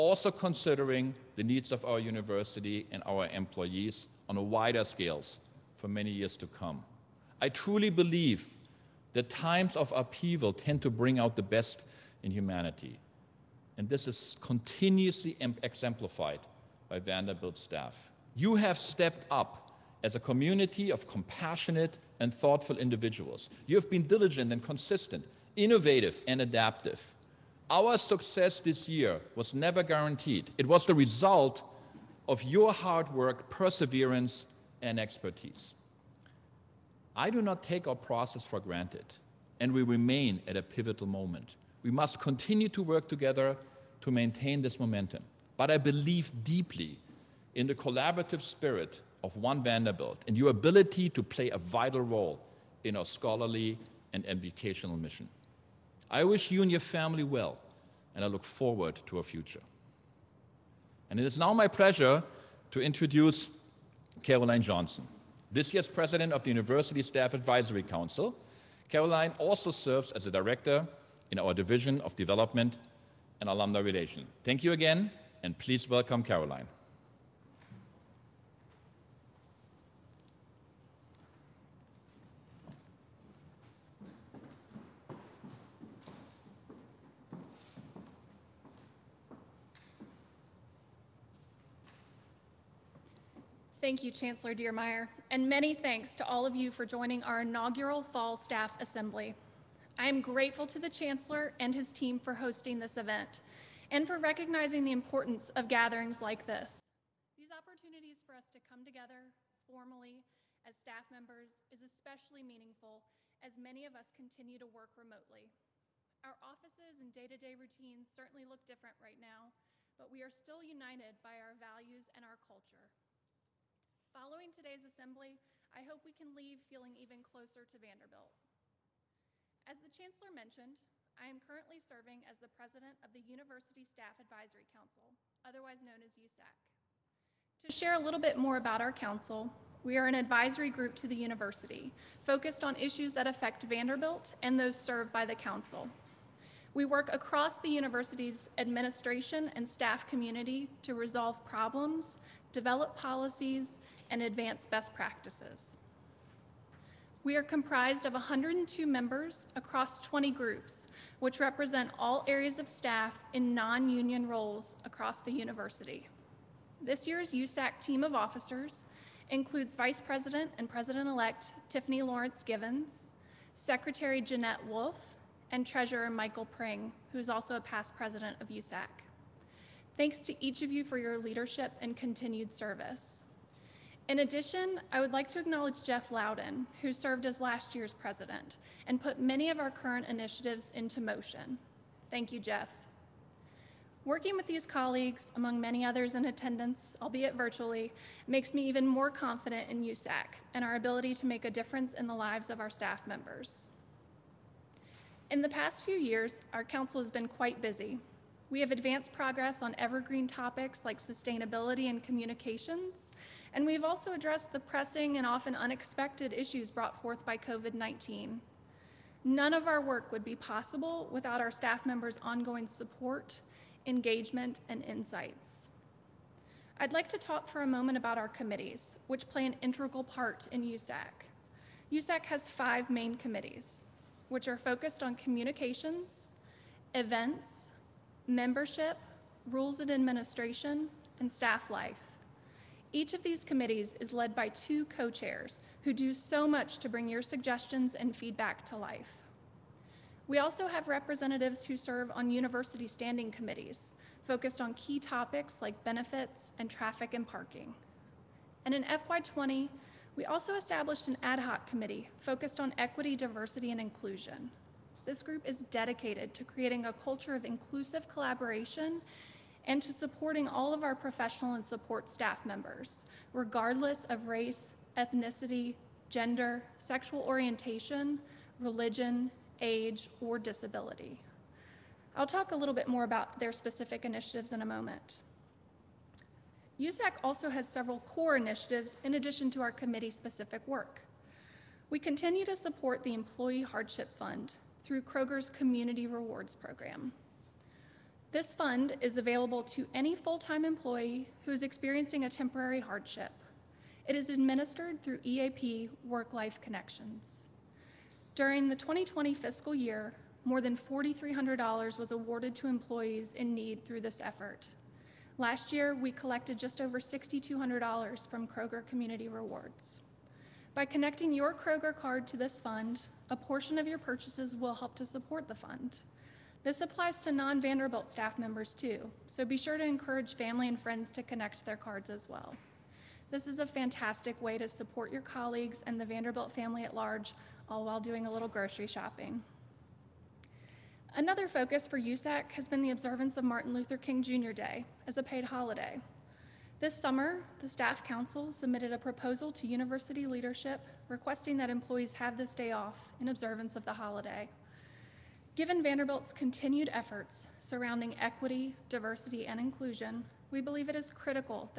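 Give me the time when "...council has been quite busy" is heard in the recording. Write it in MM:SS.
03:26.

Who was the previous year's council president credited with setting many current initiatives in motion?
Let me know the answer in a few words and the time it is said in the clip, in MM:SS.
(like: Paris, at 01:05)
Jeff Loudon, at 03:05.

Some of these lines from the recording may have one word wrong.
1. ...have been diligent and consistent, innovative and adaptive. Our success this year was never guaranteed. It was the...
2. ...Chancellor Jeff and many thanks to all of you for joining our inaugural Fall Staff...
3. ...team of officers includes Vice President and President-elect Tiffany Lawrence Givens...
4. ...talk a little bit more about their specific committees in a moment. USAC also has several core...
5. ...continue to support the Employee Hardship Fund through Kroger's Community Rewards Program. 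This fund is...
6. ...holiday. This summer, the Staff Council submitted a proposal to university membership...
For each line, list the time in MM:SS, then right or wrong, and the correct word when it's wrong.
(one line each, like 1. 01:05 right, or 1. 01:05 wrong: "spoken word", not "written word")
1. 00:23 right
2. 01:34 wrong: "Diermeier", not "Jeff"
3. 02:47 right
4. 04:42 wrong: "initiatives", not "committees"
5. 04:51 right
6. 05:45 wrong: "leadership", not "membership".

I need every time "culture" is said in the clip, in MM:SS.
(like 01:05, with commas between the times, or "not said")
02:02, 04:26.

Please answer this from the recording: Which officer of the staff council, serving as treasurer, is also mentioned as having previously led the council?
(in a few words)
Michael Pring.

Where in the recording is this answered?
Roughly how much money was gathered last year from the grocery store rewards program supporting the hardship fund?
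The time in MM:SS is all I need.
05:17.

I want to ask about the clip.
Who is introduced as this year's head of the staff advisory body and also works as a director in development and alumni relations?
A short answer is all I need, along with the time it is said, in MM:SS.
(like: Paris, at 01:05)
Caroline Johnston, at 01:04.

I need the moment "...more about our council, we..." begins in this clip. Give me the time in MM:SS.
02:18.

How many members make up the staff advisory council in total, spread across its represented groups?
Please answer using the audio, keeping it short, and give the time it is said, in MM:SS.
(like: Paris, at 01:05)
102, at 02:38.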